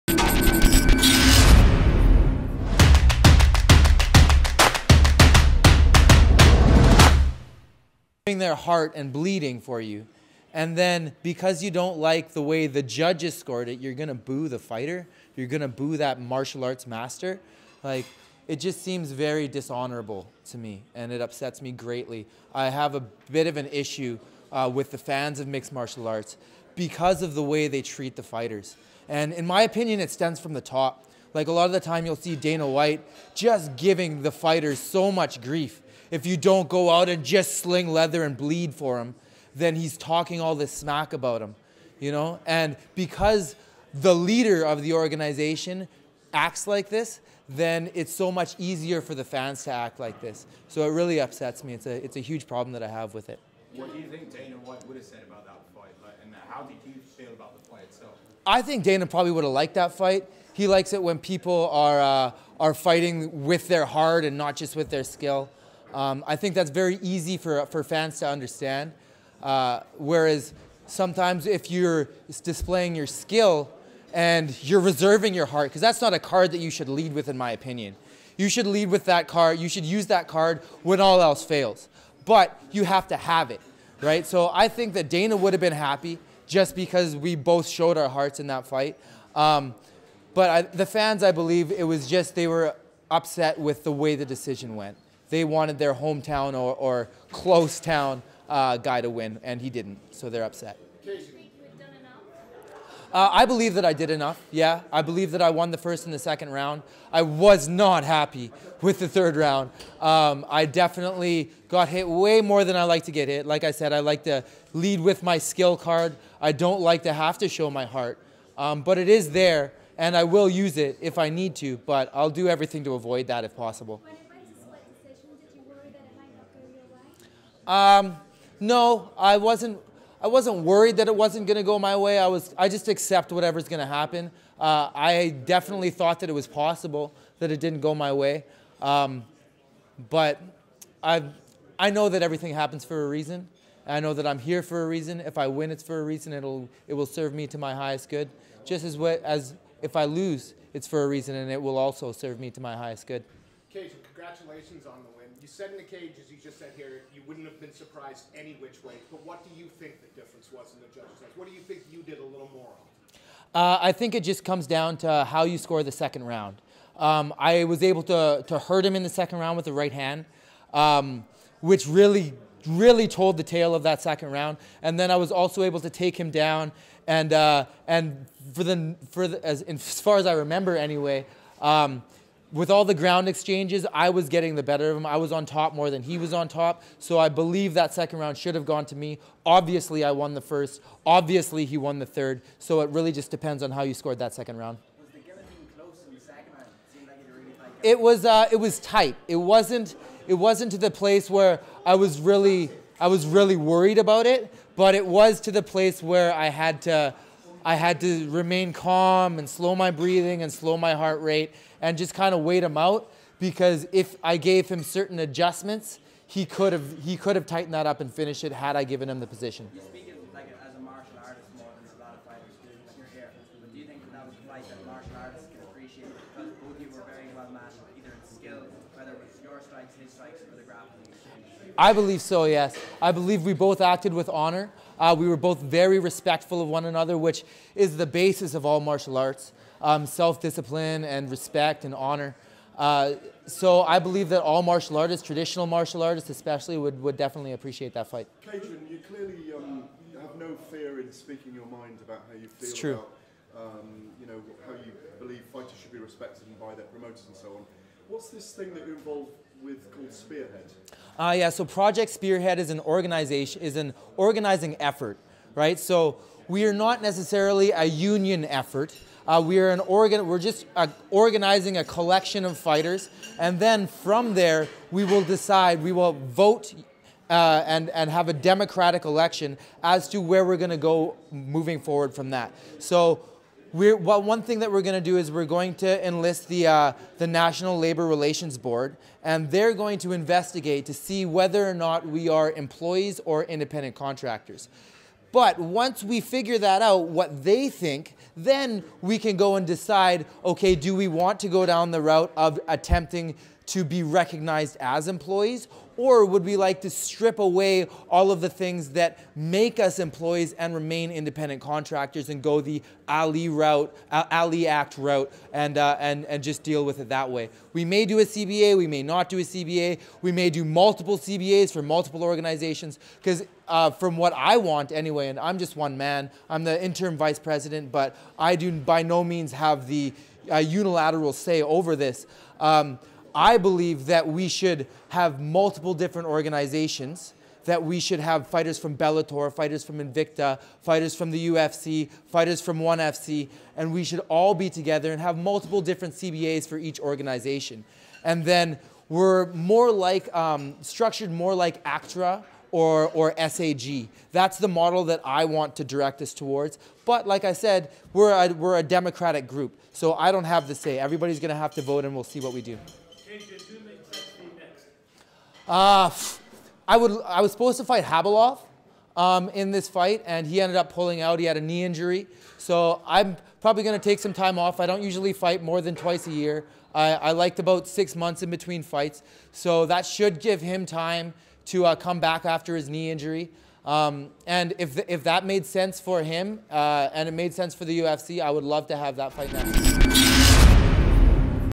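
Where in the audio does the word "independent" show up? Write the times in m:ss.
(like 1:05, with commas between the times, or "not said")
4:53, 5:11.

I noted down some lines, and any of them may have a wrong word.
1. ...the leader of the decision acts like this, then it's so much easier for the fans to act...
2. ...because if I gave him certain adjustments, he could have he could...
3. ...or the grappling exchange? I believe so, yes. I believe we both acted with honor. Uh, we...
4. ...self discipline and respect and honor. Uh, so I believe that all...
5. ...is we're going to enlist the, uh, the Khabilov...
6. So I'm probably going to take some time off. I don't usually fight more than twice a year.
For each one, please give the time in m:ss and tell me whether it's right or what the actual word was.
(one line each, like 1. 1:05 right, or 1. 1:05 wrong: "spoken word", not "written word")
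1. 0:43 wrong: "organization", not "decision"
2. 3:33 right
3. 3:50 right
4. 4:00 right
5. 4:45 wrong: "National", not "Khabilov"
6. 6:12 right.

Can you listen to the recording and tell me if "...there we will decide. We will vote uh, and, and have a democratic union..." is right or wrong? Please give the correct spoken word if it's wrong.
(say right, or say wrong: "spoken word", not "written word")
wrong: "election", not "union".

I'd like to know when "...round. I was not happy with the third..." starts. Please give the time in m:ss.
1:46.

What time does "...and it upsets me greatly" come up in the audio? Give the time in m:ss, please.
0:20.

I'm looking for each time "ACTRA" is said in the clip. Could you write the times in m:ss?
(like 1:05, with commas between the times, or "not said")
5:51.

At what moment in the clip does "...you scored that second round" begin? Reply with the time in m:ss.
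3:13.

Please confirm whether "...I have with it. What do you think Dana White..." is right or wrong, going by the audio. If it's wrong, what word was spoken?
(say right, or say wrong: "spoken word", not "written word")
right.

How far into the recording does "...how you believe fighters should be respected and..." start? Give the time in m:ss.
4:14.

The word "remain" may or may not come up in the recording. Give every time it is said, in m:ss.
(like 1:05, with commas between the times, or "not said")
3:28, 5:10.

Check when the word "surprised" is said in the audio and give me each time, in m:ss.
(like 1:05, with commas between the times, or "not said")
2:37.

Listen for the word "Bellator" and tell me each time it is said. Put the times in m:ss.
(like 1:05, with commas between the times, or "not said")
5:38.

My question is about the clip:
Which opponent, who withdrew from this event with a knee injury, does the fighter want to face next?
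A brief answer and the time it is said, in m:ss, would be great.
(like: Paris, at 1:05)
Khabilov, at 6:08.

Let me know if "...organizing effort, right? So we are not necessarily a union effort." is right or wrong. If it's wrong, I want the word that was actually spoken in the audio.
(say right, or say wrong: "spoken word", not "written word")
right.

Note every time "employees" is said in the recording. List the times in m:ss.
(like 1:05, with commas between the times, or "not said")
4:52, 5:05, 5:09.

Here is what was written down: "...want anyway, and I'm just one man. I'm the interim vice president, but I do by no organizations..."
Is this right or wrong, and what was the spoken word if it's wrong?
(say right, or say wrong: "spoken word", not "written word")
wrong: "means", not "organizations".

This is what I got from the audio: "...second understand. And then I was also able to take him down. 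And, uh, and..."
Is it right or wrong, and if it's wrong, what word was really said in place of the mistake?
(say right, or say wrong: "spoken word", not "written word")
wrong: "round", not "understand".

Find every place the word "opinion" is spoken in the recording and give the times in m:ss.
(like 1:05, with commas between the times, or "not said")
0:29, 1:17.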